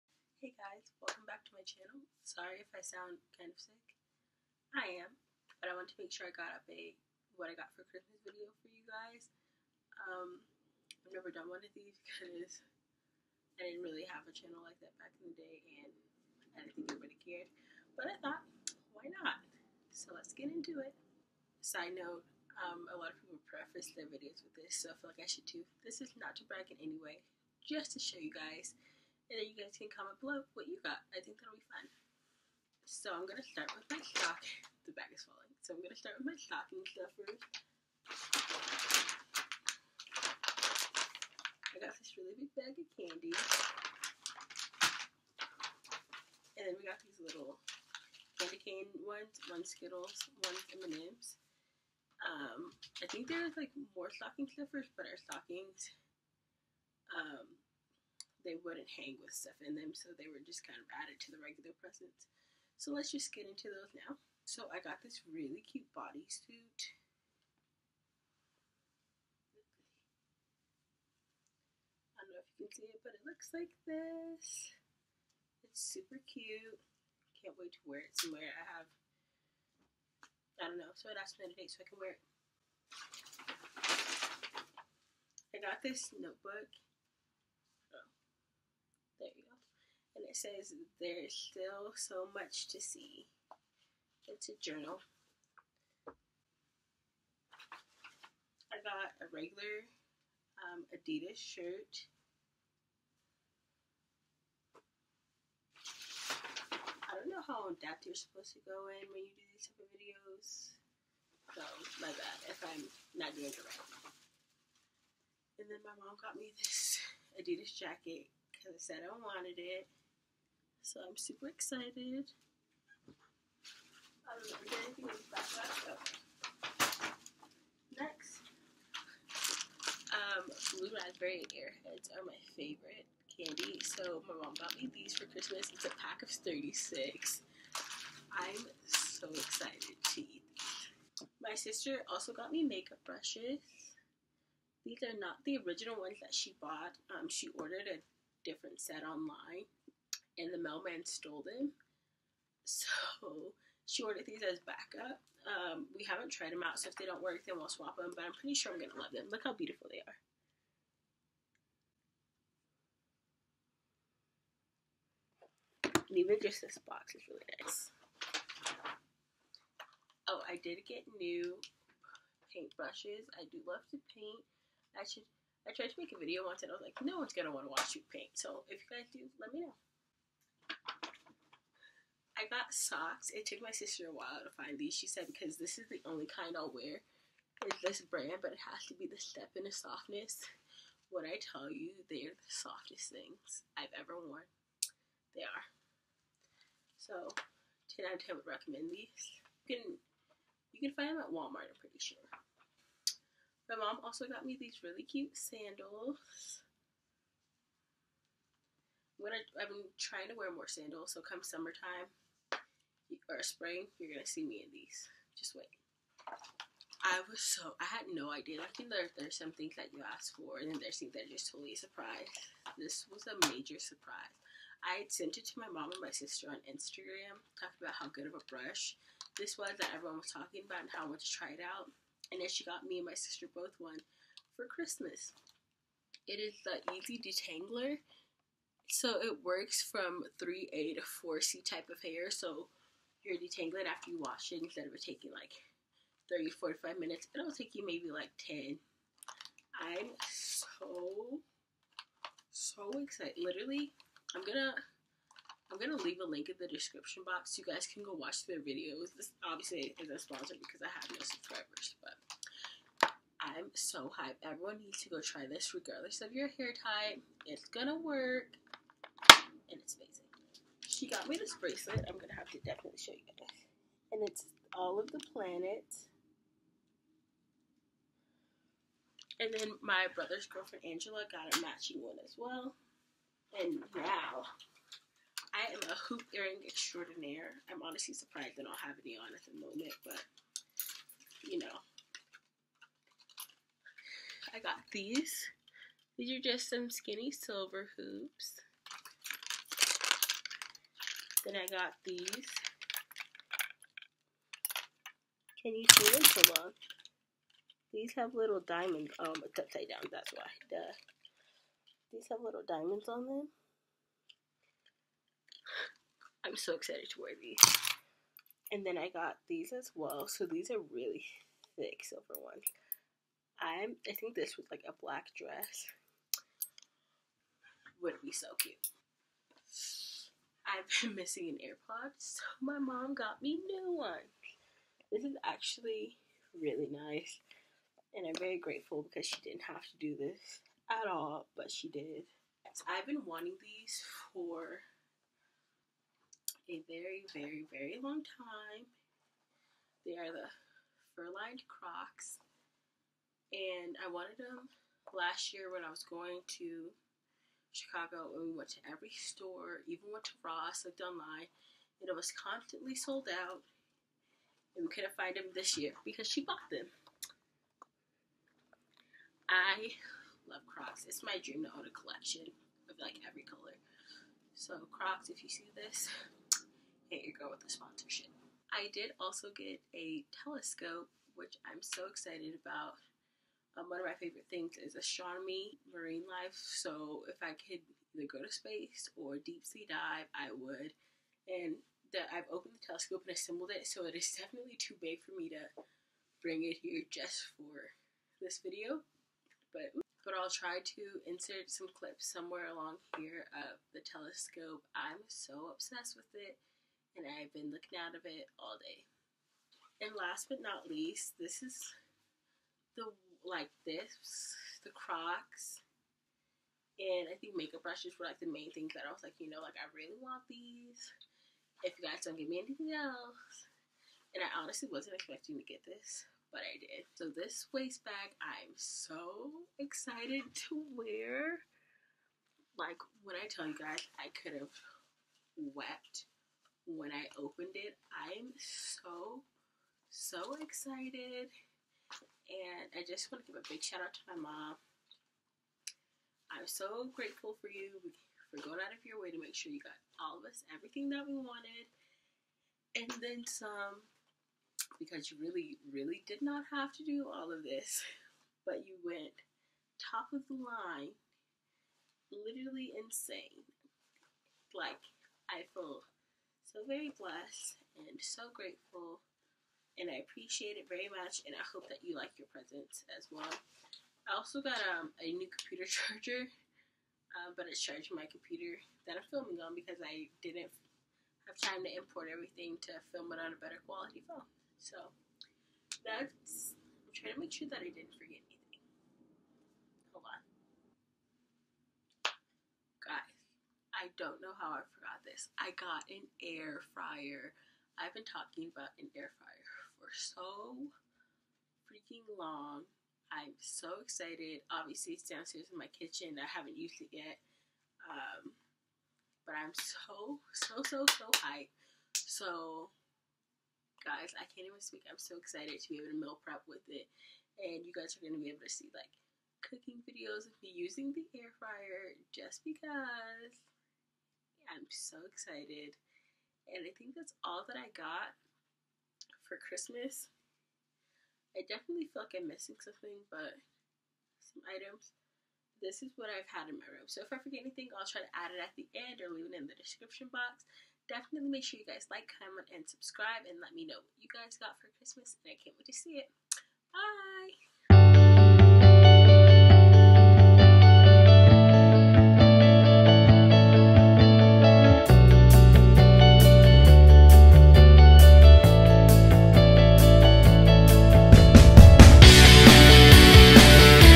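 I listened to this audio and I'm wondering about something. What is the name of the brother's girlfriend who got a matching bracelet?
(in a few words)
Angela.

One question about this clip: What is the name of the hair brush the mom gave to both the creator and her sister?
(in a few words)
EZ Detangler.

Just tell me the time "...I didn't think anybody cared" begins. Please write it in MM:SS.
00:16.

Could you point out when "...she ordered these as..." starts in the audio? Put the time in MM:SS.
02:33.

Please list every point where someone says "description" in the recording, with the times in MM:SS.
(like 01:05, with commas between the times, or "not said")
04:16, 08:59.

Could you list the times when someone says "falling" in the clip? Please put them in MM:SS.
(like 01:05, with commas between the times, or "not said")
00:35.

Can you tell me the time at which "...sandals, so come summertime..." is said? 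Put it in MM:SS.
03:30.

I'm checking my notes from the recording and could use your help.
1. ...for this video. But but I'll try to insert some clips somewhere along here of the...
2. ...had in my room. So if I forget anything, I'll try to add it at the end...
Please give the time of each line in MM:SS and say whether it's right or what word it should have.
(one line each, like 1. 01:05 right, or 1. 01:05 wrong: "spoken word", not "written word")
1. 06:37 right
2. 08:56 right.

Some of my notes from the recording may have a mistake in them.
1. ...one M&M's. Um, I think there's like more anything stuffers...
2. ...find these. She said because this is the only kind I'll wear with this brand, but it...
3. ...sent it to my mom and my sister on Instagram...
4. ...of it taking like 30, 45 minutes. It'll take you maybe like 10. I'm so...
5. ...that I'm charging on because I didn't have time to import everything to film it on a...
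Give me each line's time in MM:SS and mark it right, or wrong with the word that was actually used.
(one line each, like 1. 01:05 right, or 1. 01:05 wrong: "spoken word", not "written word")
1. 00:50 wrong: "stocking", not "anything"
2. 03:04 right
3. 03:45 right
4. 04:04 right
5. 07:59 wrong: "filming", not "charging".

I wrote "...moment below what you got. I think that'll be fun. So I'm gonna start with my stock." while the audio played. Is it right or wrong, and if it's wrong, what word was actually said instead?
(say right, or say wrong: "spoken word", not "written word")
wrong: "comment", not "moment".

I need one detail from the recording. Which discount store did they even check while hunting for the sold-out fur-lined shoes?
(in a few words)
Ross.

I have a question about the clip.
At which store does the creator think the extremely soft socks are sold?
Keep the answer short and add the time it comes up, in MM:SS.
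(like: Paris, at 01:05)
Walmart, at 03:21.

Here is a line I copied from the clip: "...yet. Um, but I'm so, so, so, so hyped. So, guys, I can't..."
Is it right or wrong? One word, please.
right.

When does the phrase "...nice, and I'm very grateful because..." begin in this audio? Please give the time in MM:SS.
05:36.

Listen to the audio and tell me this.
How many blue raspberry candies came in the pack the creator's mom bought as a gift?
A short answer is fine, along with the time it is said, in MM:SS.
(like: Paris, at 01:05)
36, at 02:16.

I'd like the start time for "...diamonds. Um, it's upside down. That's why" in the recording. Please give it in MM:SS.
05:08.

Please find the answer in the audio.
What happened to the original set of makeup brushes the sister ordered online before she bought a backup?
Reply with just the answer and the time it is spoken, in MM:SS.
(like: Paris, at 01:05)
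Mailman stole them, at 02:30.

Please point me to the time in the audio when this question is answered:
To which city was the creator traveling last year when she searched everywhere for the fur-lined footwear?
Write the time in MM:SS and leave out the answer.
05:57.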